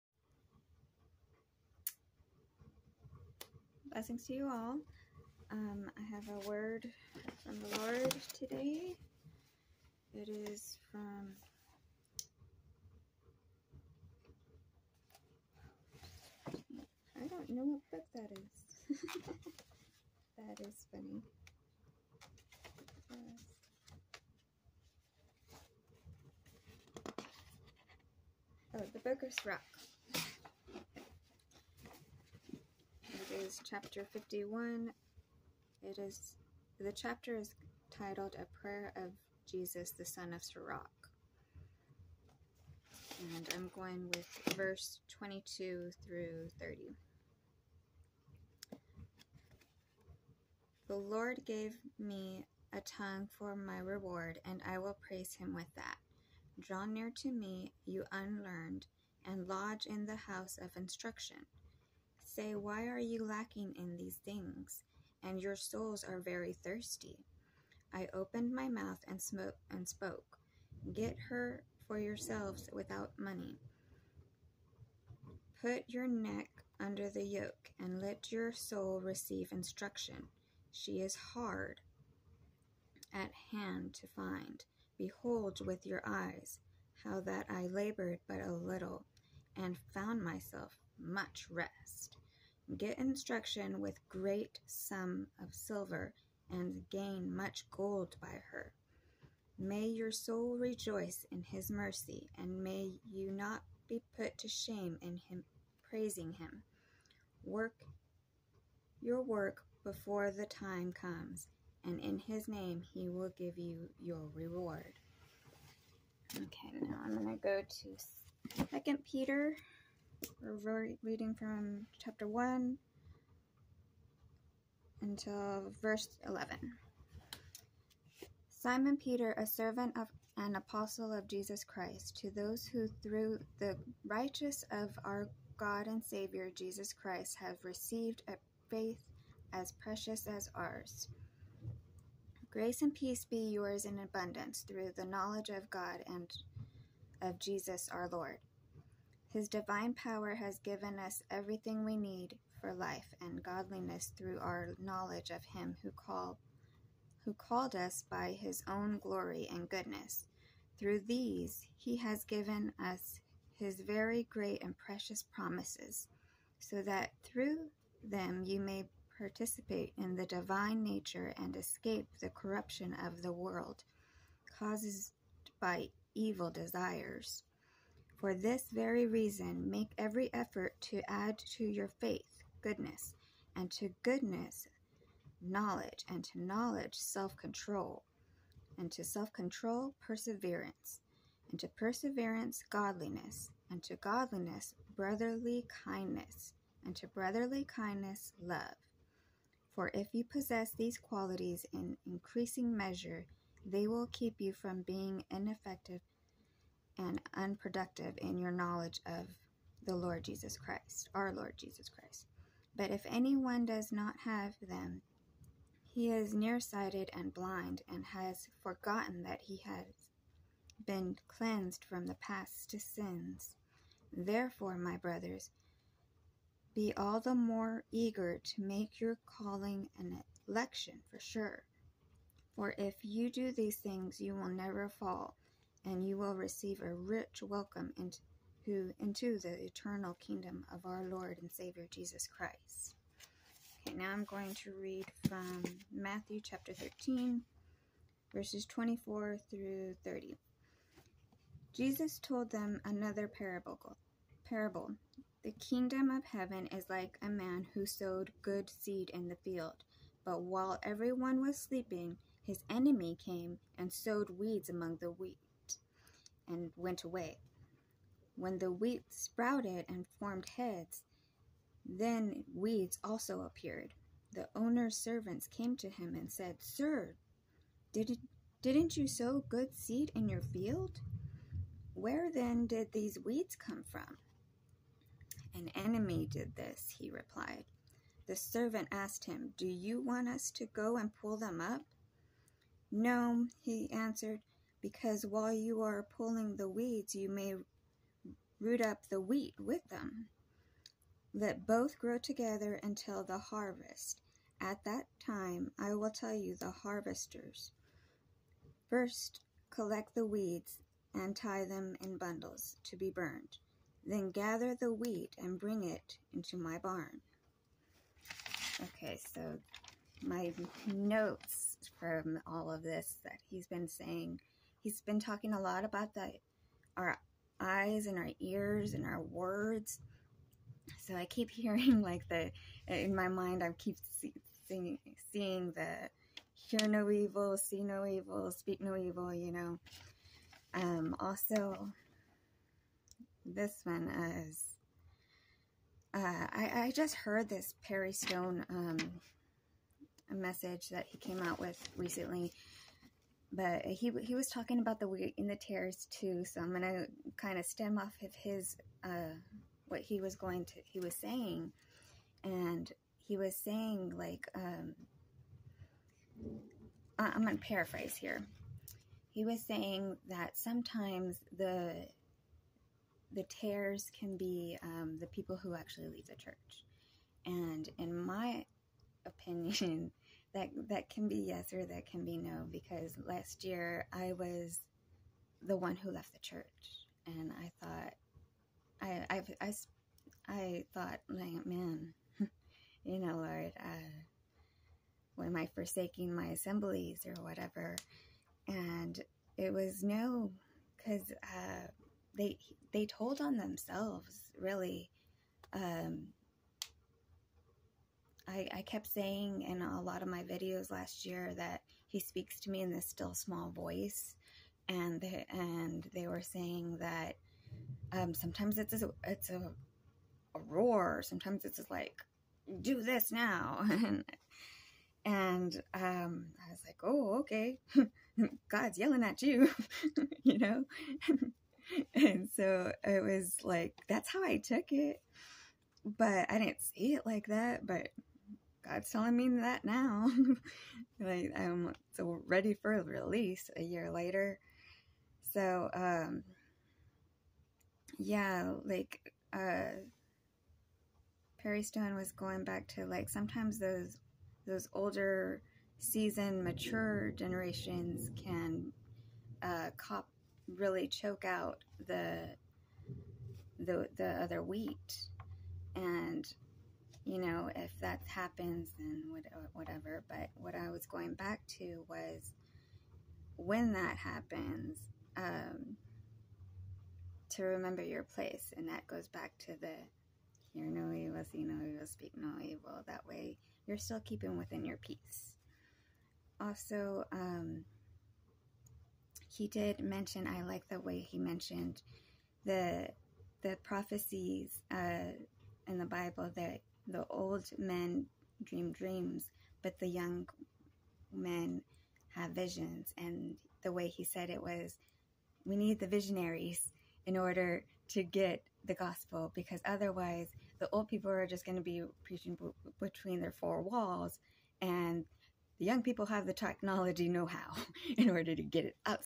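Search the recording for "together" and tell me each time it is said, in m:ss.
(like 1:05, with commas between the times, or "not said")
5:02.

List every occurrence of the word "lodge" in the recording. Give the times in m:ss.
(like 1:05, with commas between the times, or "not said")
0:59.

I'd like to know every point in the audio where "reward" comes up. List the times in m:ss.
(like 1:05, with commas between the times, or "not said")
0:53, 1:54.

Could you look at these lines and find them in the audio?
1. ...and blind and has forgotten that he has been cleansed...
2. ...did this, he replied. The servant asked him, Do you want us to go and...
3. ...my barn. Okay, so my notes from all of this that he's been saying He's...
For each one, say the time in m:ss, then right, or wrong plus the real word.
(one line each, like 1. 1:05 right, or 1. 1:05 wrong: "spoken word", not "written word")
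1. 3:37 right
2. 4:46 right
3. 5:16 right.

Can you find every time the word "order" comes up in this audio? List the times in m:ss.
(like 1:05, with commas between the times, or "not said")
8:27, 8:38.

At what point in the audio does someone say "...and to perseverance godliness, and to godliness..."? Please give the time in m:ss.
3:11.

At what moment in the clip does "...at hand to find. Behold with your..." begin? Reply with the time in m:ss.
1:23.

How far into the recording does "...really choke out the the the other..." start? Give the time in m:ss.
7:40.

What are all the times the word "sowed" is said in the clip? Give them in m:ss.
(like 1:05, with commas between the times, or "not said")
4:17, 4:23.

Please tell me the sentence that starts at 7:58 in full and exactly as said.
And that goes back to the hear no evil, see no evil, speak no evil.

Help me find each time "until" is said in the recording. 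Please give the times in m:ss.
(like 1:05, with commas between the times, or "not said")
2:05, 5:02.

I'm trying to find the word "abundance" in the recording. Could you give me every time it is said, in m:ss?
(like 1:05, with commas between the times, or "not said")
2:23.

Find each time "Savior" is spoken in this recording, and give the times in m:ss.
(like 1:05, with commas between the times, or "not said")
2:16, 4:01.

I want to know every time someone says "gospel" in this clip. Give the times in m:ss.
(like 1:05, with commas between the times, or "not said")
8:28.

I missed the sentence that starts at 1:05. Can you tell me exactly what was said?
And your souls are very thirsty.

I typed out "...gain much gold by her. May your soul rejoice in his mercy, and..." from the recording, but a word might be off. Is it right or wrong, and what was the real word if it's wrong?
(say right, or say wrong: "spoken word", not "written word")
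right.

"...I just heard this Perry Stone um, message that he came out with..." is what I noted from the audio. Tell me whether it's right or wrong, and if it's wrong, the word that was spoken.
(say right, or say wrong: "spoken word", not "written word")
right.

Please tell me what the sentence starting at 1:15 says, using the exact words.
Put your neck under the yoke and let your soul receive instruction.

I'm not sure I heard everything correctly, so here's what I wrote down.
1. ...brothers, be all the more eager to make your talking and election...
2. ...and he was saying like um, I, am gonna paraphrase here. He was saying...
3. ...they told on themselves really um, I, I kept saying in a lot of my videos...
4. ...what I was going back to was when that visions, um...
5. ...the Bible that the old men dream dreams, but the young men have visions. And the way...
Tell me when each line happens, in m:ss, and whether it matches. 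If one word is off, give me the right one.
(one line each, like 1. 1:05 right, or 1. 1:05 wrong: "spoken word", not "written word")
1. 3:44 wrong: "calling", not "talking"
2. 6:02 right
3. 6:42 right
4. 7:50 wrong: "happens", not "visions"
5. 8:15 right.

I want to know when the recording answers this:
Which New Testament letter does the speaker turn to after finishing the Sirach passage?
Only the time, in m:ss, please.
1:58.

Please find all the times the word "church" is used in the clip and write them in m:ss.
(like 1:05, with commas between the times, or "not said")
6:16, 6:26.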